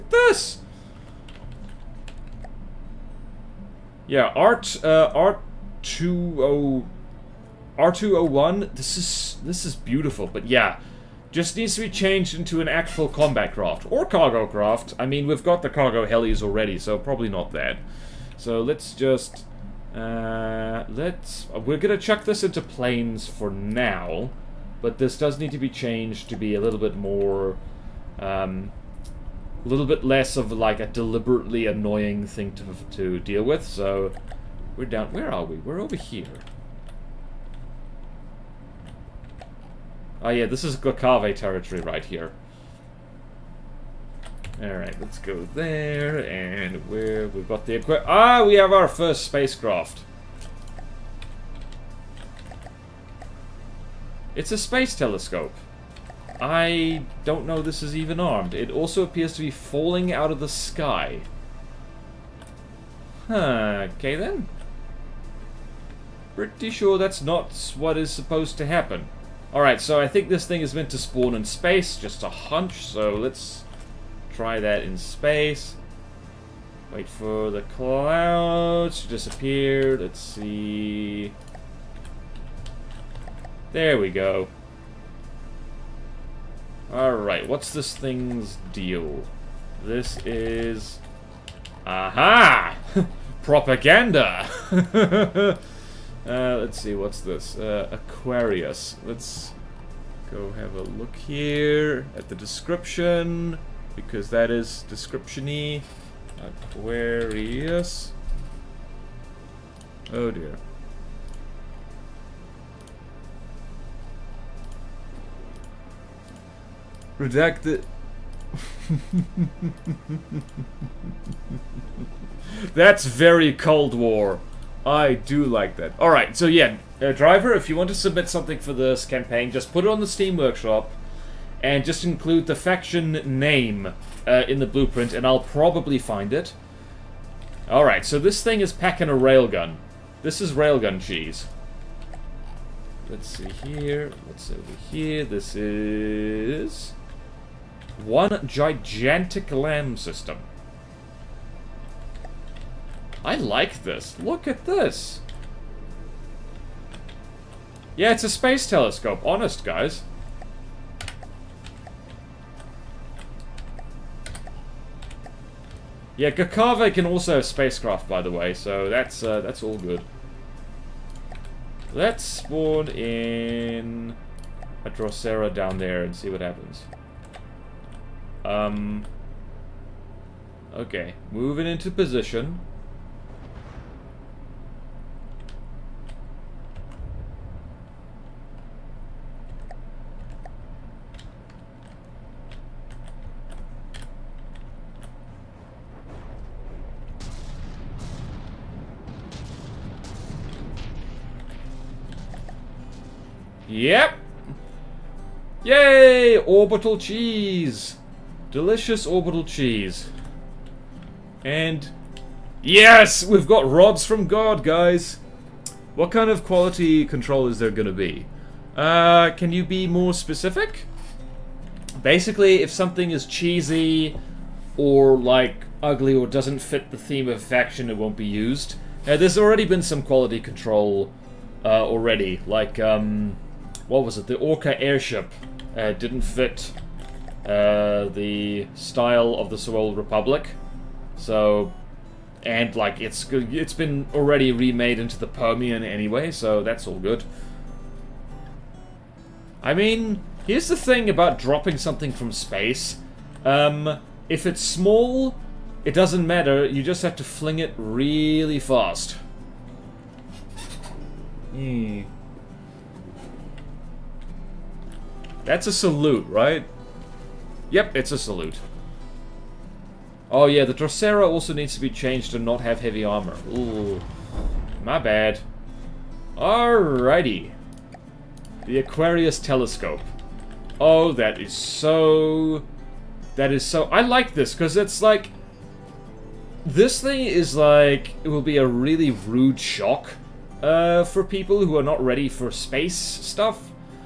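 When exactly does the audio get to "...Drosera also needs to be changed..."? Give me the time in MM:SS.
04:30.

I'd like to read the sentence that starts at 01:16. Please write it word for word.
Wait for the clouds to disappear.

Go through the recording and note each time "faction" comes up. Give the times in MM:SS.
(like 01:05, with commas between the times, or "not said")
02:12, 03:47.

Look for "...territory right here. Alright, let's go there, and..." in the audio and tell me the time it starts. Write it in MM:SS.
00:41.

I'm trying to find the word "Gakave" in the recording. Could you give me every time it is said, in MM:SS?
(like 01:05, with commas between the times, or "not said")
02:46.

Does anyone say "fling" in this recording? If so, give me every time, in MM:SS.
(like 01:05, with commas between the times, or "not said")
04:17.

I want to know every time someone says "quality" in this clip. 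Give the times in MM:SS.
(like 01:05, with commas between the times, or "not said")
03:36, 03:50.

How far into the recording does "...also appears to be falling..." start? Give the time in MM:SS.
00:58.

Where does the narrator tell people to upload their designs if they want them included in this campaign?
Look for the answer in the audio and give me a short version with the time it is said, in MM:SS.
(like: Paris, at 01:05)
Steam Workshop, at 02:10.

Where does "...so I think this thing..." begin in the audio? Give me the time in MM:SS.
01:09.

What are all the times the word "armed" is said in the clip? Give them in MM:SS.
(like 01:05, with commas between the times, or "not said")
00:58.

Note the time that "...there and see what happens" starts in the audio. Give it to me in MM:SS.
02:55.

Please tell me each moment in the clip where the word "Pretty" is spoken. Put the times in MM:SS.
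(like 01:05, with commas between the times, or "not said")
01:06.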